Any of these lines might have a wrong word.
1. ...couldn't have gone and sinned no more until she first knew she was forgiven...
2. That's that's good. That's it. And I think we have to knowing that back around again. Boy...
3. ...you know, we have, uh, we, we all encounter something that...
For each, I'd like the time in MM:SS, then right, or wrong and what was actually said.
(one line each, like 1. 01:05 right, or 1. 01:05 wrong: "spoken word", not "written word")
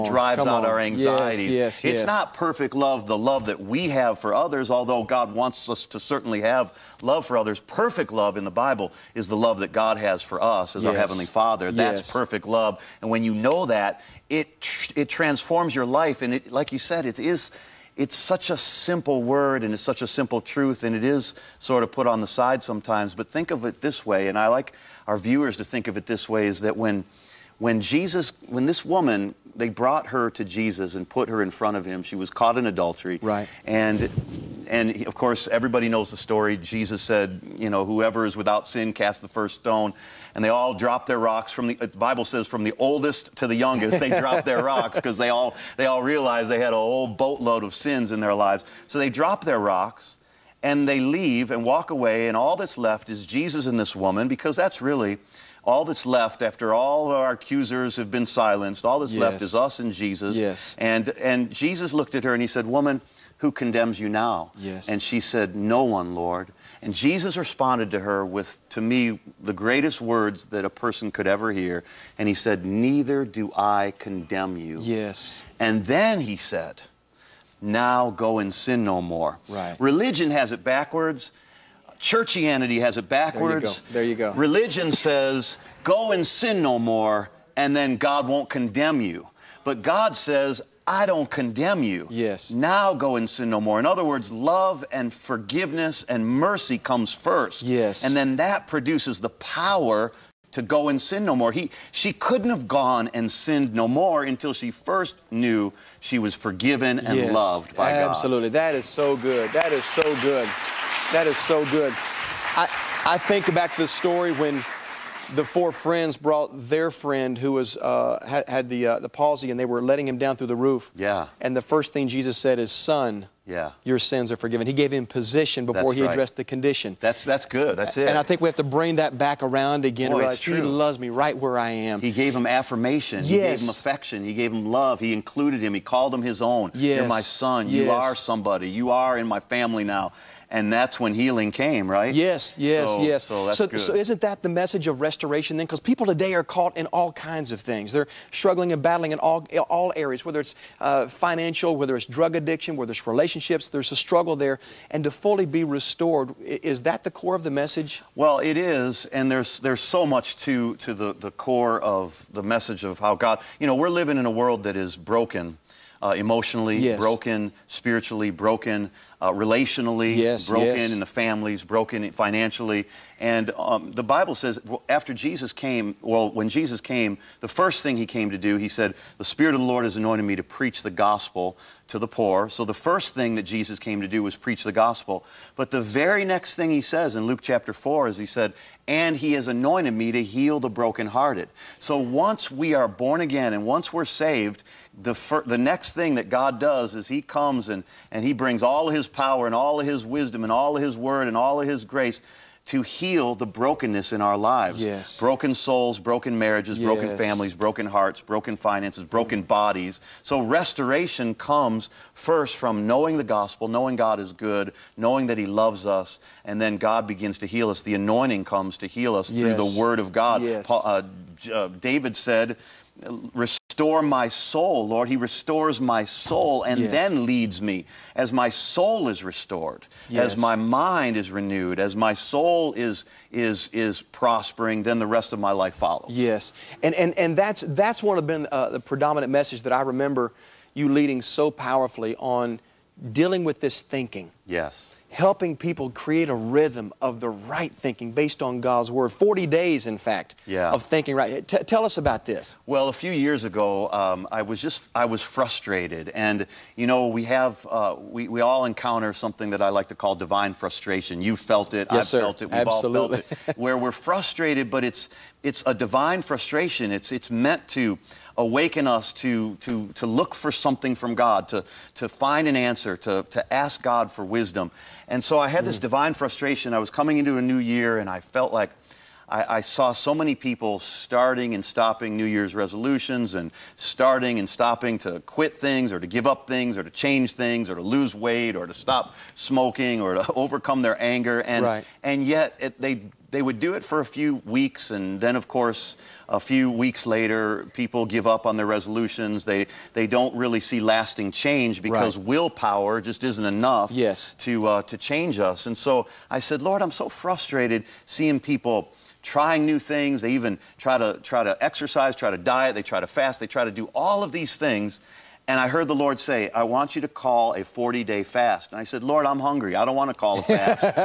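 1. 01:42 right
2. 02:06 wrong: "bring", not "knowing"
3. 04:16 right.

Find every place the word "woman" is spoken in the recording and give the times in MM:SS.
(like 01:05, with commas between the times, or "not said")
00:28, 00:53, 01:02.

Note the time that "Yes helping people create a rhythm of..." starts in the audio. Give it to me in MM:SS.
04:04.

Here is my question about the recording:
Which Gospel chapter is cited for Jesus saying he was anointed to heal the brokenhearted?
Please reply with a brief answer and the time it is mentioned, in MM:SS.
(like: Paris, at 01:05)
Luke chapter 4, at 03:07.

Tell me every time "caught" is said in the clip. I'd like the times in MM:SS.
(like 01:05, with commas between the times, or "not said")
00:32, 02:26.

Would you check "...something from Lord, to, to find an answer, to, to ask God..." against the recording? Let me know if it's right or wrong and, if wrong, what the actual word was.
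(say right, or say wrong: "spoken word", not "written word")
wrong: "God", not "Lord".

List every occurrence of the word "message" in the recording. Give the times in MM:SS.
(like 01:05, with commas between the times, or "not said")
02:24, 02:37, 02:42, 03:59.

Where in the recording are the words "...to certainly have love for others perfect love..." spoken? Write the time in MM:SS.
00:05.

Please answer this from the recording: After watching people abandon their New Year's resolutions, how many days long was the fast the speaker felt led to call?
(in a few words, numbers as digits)
40.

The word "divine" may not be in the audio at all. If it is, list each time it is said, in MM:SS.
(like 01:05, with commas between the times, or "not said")
04:20, 04:25, 04:35.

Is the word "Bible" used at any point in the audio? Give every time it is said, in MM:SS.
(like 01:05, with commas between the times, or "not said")
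00:08, 00:41, 02:54.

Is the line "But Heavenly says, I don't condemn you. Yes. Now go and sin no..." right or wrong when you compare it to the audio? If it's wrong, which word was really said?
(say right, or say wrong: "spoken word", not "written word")
wrong: "God", not "Heavenly".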